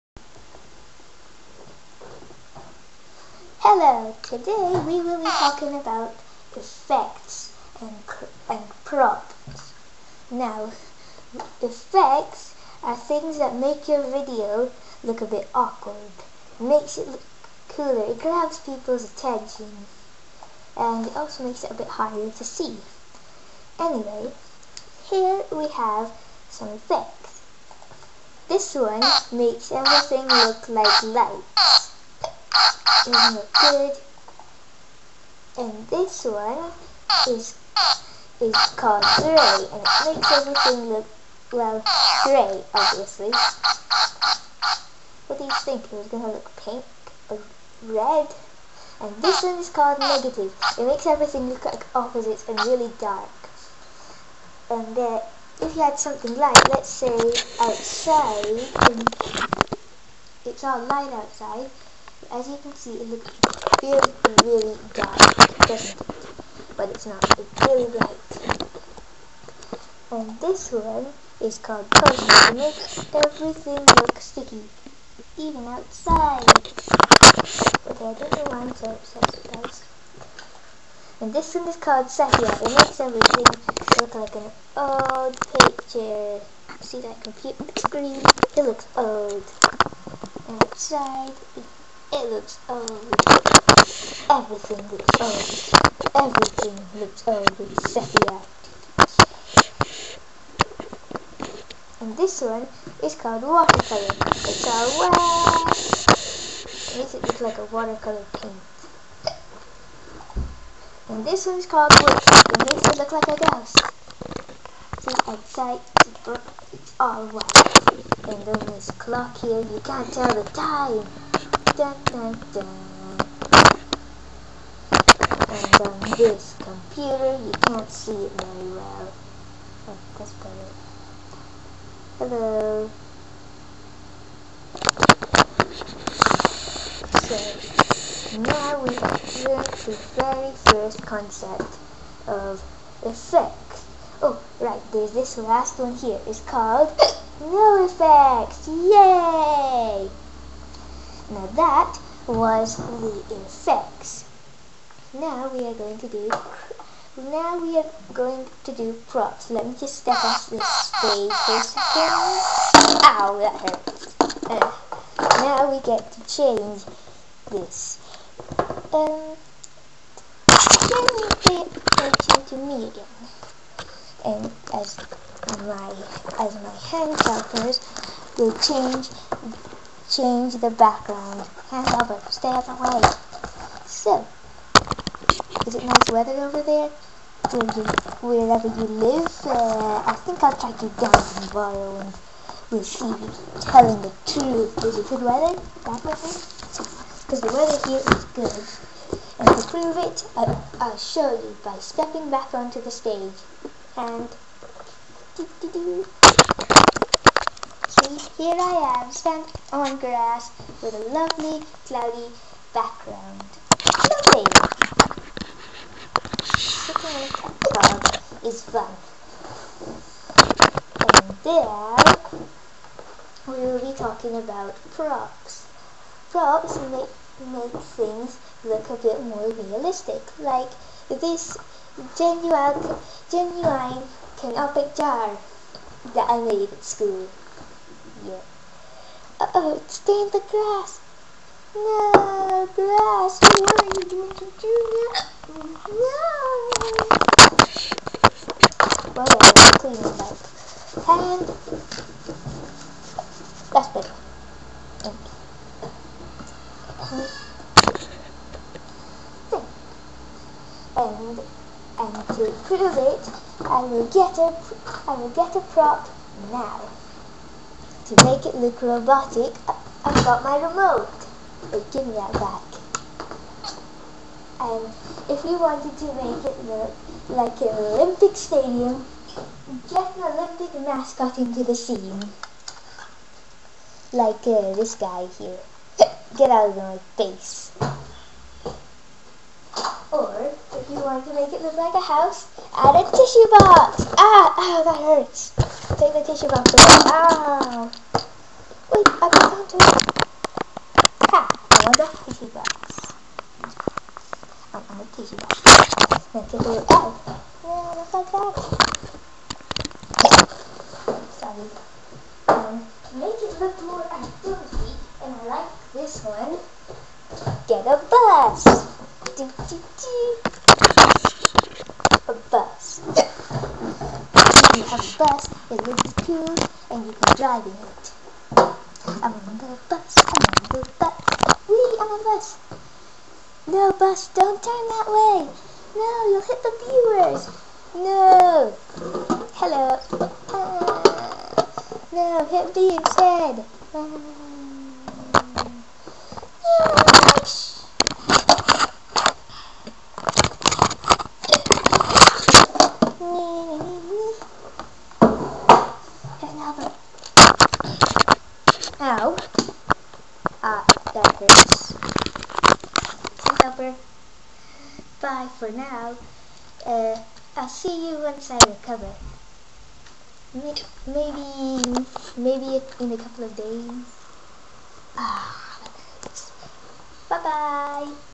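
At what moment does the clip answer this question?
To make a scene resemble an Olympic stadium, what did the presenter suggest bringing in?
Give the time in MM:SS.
04:40.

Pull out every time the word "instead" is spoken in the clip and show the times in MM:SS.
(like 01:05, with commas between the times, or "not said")
05:42.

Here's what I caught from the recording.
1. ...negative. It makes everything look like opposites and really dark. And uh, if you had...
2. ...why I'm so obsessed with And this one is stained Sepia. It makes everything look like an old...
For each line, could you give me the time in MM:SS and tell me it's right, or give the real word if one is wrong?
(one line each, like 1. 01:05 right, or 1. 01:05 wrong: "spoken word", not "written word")
1. 00:49 right
2. 01:18 wrong: "called", not "stained".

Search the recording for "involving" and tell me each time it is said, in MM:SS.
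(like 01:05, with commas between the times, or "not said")
not said.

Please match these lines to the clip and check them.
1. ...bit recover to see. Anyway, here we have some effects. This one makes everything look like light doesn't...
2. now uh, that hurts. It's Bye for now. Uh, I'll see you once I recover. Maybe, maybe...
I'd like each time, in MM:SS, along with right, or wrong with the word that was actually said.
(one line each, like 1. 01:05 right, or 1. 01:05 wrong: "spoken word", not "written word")
1. 00:21 wrong: "harder", not "recover"
2. 05:59 right.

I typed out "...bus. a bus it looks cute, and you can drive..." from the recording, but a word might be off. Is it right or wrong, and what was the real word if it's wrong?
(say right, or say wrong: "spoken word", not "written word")
right.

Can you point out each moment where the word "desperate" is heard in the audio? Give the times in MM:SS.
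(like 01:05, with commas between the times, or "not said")
not said.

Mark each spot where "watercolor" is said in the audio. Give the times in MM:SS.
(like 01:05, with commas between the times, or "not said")
01:43, 01:47.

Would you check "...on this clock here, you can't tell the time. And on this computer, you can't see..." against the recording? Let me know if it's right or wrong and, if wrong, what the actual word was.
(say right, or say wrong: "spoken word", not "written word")
right.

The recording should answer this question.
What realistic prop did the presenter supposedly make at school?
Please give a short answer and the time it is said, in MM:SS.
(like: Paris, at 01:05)
Canopic jar, at 03:54.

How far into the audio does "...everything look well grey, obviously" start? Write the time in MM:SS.
00:40.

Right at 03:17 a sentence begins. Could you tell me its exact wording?
Because the weather here is good.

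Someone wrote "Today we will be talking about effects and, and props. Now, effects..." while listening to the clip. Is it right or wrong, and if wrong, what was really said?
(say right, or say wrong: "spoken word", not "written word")
right.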